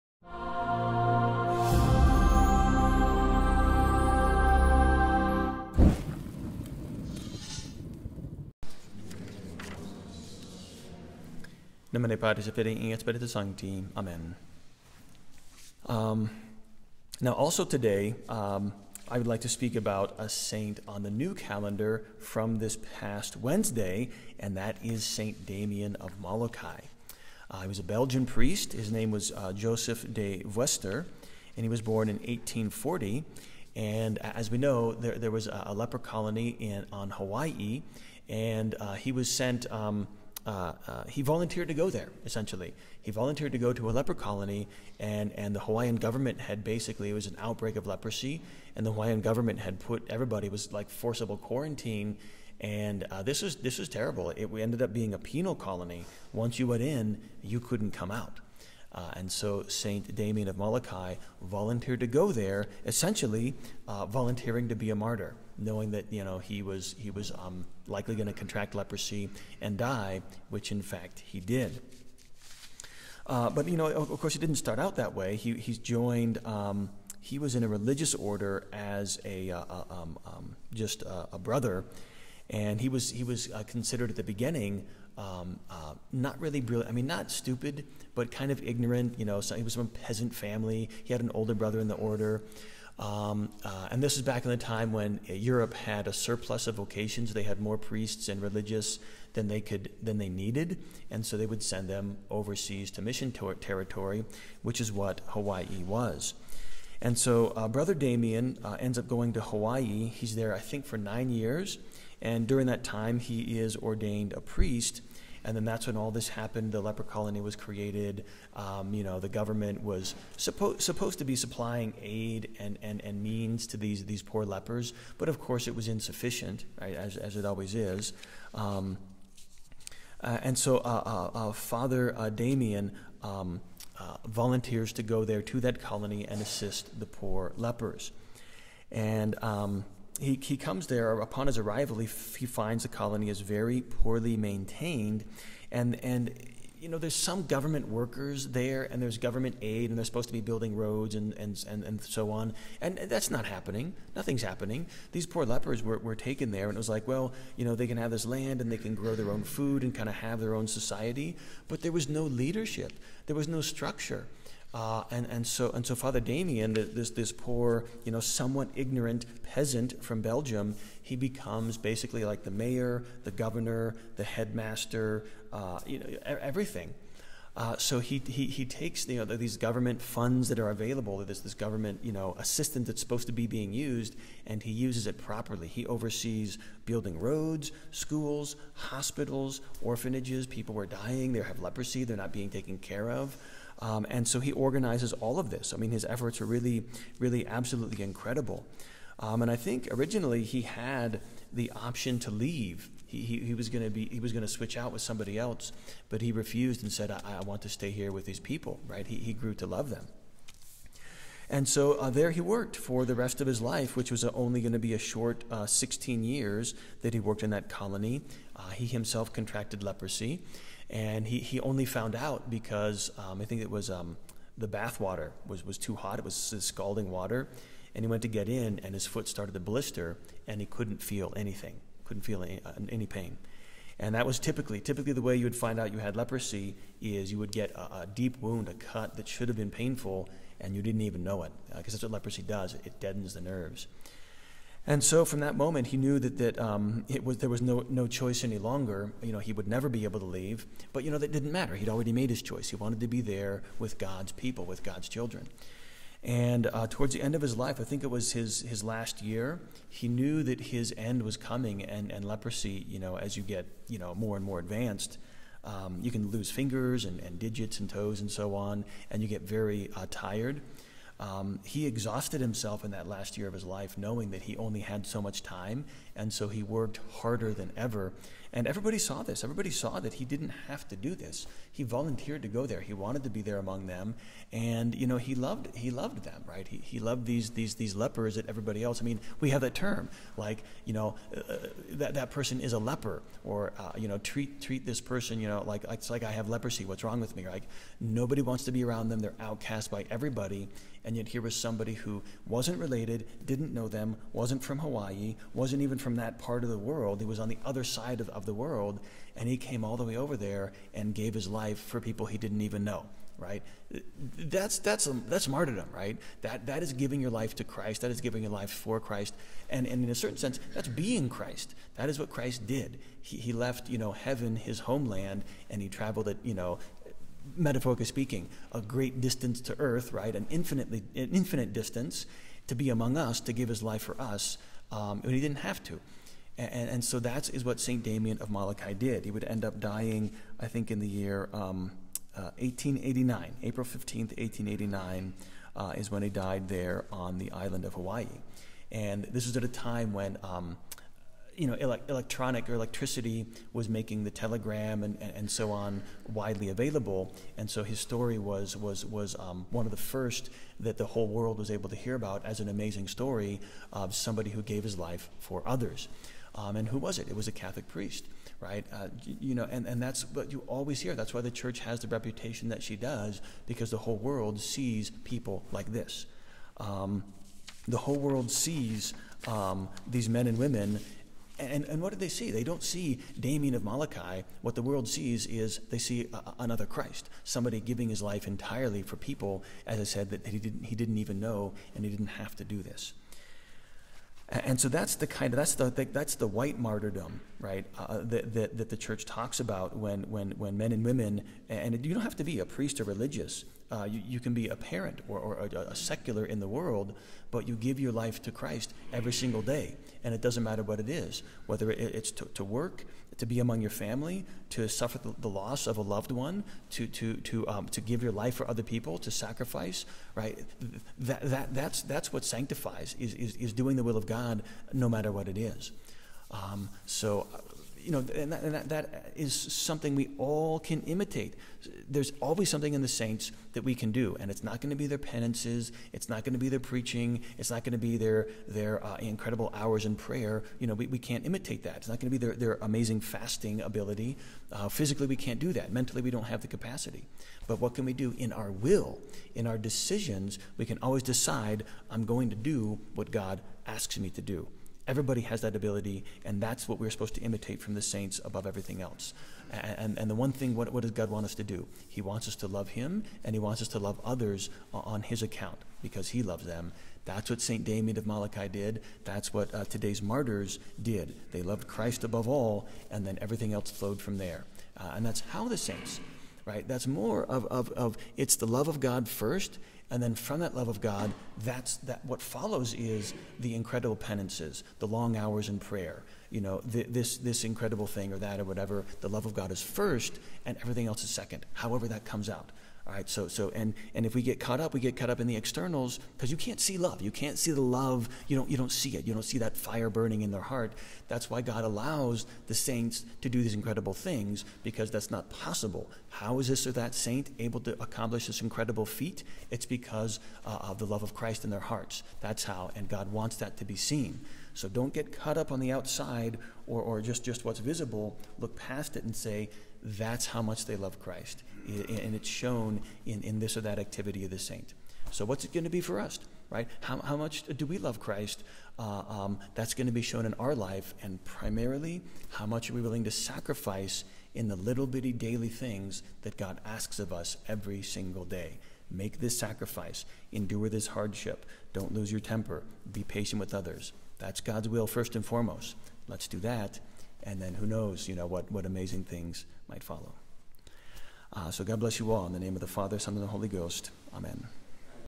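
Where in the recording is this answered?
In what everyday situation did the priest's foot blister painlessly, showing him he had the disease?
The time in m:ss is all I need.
3:44.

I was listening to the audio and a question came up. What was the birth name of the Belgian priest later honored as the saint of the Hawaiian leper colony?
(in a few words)
Joseph De Veuster.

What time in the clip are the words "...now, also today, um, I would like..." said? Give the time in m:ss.
0:17.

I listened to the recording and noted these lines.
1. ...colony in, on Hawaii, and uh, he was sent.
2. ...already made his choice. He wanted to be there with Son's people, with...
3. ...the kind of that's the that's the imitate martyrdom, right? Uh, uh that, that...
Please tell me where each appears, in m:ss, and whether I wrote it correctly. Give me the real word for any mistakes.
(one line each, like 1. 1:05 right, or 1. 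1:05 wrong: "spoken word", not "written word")
1. 0:35 right
2. 4:11 wrong: "God", not "Son"
3. 6:35 wrong: "white", not "imitate".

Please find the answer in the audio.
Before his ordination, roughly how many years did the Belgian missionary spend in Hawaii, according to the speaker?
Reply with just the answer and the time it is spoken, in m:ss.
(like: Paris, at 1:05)
9, at 1:50.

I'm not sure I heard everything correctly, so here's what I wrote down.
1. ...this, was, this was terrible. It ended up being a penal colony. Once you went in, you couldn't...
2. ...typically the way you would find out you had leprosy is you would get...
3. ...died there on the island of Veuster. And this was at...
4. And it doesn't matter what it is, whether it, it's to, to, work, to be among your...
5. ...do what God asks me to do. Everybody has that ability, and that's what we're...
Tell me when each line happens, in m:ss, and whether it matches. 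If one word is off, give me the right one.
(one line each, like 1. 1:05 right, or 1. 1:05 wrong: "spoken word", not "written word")
1. 0:53 right
2. 3:54 right
3. 5:46 wrong: "Hawaii", not "Veuster"
4. 6:50 right
5. 7:32 right.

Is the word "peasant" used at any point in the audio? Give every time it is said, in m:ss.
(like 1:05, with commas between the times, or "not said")
1:30, 2:49.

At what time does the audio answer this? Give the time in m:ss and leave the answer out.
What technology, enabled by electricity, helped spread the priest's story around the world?
5:54.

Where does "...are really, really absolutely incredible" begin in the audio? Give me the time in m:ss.
3:16.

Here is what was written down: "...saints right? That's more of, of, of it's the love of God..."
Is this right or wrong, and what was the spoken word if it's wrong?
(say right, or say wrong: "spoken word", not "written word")
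right.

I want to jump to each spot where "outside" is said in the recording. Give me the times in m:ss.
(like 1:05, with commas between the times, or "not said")
8:35.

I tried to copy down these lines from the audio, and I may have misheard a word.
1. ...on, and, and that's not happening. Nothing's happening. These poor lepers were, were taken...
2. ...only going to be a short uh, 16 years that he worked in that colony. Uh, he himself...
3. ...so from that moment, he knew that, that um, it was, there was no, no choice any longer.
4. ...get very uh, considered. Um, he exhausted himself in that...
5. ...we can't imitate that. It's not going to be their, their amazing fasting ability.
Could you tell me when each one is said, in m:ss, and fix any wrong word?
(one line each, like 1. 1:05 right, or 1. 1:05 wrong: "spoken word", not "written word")
1. 2:32 right
2. 3:34 right
3. 4:05 right
4. 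4:29 wrong: "tired", not "considered"
5. 7:21 right.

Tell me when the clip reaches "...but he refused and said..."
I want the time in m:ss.
3:26.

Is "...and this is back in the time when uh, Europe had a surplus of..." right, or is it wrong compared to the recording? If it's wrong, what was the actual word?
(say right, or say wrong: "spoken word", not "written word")
right.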